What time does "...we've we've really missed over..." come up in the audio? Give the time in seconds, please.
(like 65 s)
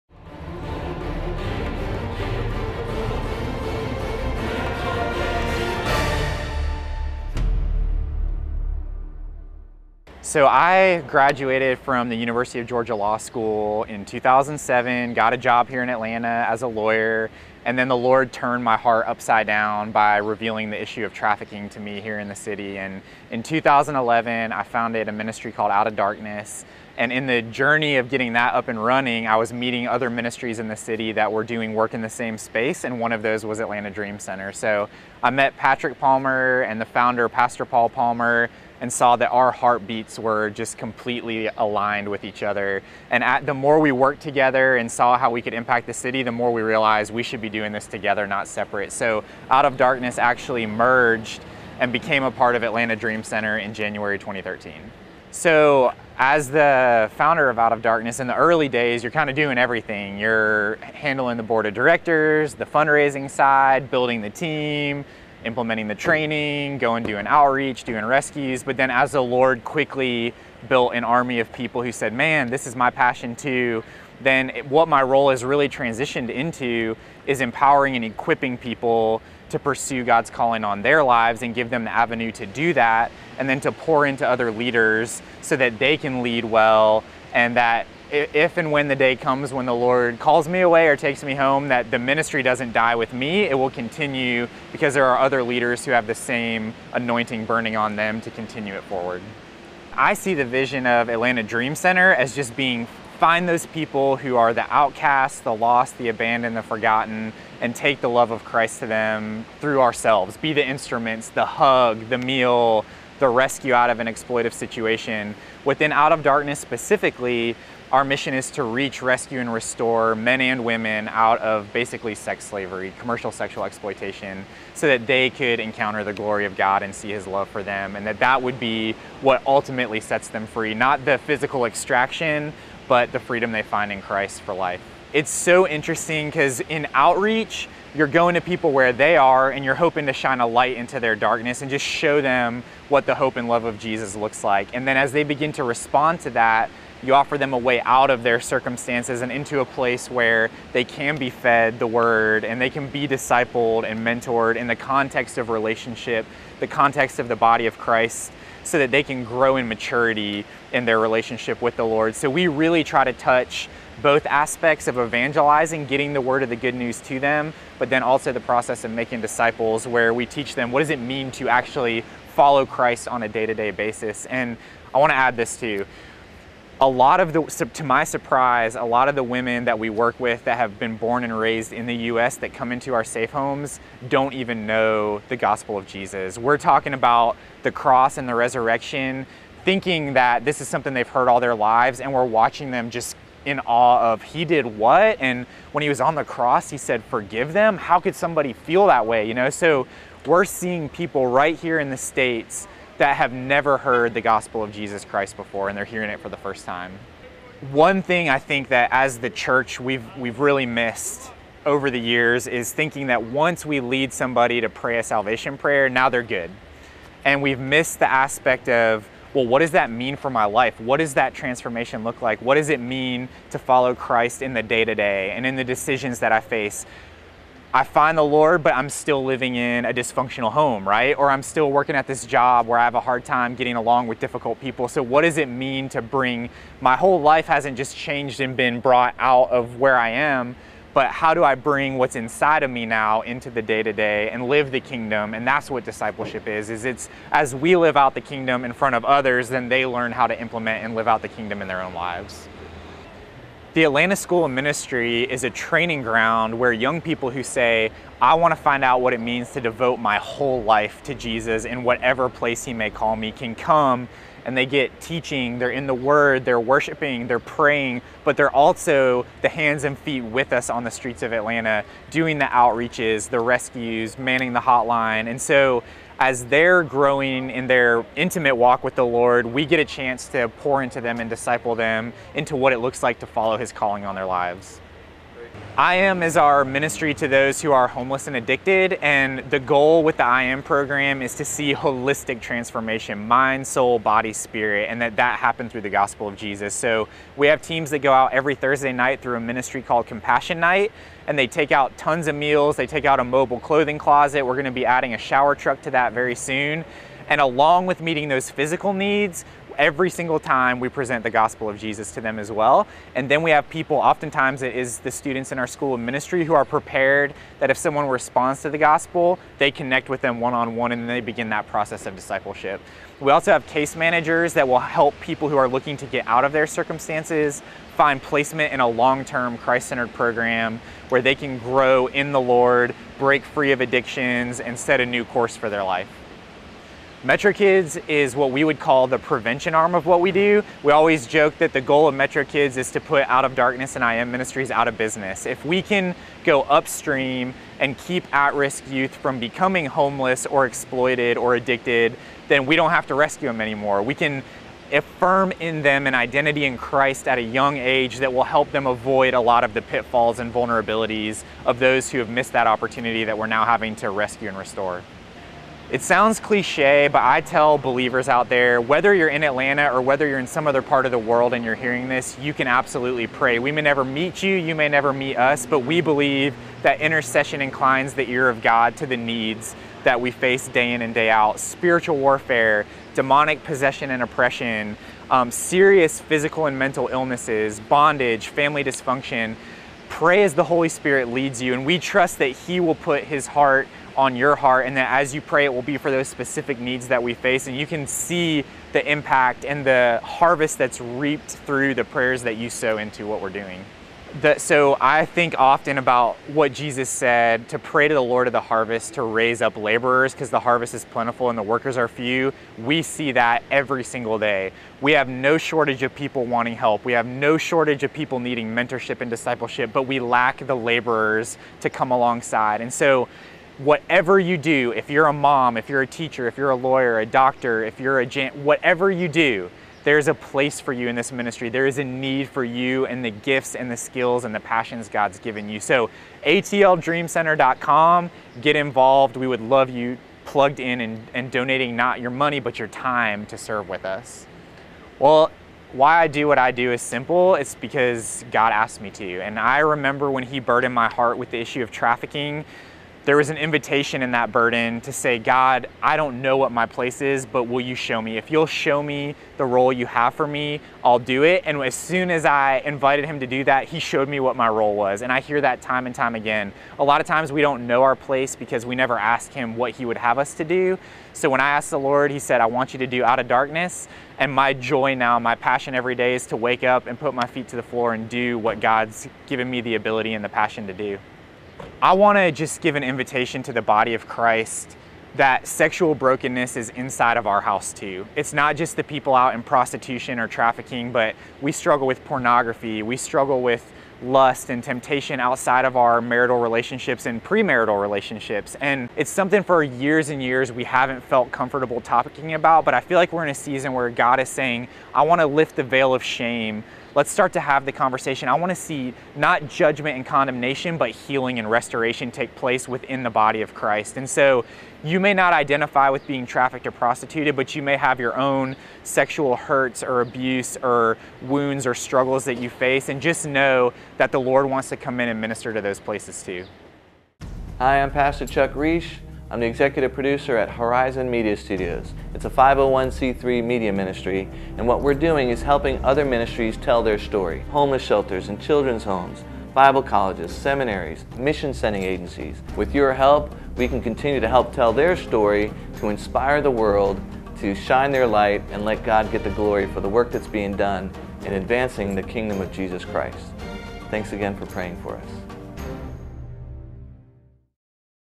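209 s.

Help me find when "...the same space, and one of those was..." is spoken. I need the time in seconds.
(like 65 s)
32 s.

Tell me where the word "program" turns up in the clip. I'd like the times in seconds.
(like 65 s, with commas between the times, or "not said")
290 s, 330 s.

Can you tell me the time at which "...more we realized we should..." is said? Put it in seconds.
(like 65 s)
46 s.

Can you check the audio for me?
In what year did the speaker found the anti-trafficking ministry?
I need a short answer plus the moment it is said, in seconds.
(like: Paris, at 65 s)
2011, at 23 s.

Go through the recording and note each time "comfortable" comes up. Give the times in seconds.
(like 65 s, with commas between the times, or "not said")
501 s.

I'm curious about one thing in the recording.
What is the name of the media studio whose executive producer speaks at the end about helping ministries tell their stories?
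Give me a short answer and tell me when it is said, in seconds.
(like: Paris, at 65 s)
Horizon Media Studios, at 530 s.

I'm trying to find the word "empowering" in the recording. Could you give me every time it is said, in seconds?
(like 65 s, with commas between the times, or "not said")
77 s.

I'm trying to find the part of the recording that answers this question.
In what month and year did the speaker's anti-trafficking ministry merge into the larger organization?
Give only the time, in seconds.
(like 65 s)
53 s.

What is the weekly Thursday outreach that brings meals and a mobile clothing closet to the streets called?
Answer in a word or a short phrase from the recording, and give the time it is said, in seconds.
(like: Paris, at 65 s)
Compassion Night, at 300 s.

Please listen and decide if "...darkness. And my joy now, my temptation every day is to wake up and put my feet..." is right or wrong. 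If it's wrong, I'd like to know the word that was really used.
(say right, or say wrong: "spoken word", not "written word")
wrong: "passion", not "temptation".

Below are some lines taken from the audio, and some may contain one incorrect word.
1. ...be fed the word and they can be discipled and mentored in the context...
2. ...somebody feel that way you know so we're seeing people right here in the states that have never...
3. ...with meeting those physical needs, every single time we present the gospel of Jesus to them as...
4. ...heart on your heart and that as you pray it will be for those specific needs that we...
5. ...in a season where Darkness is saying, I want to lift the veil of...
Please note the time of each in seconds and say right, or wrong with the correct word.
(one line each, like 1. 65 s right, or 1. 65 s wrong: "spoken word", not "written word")
1. 151 s right
2. 198 s right
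3. 307 s right
4. 393 s right
5. 503 s wrong: "God", not "Darkness".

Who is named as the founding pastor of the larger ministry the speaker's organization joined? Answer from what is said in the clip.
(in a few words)
Paul Palmer.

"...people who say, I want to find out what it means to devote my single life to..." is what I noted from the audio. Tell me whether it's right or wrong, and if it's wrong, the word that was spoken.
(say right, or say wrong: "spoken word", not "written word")
wrong: "whole", not "single".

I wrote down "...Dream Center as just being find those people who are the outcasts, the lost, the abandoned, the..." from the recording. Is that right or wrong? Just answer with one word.
right.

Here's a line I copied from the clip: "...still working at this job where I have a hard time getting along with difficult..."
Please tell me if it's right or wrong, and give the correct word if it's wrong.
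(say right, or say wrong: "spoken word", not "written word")
right.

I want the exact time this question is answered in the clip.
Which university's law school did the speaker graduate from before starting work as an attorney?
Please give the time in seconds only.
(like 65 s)
12 s.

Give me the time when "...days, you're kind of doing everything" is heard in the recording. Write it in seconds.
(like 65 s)
58 s.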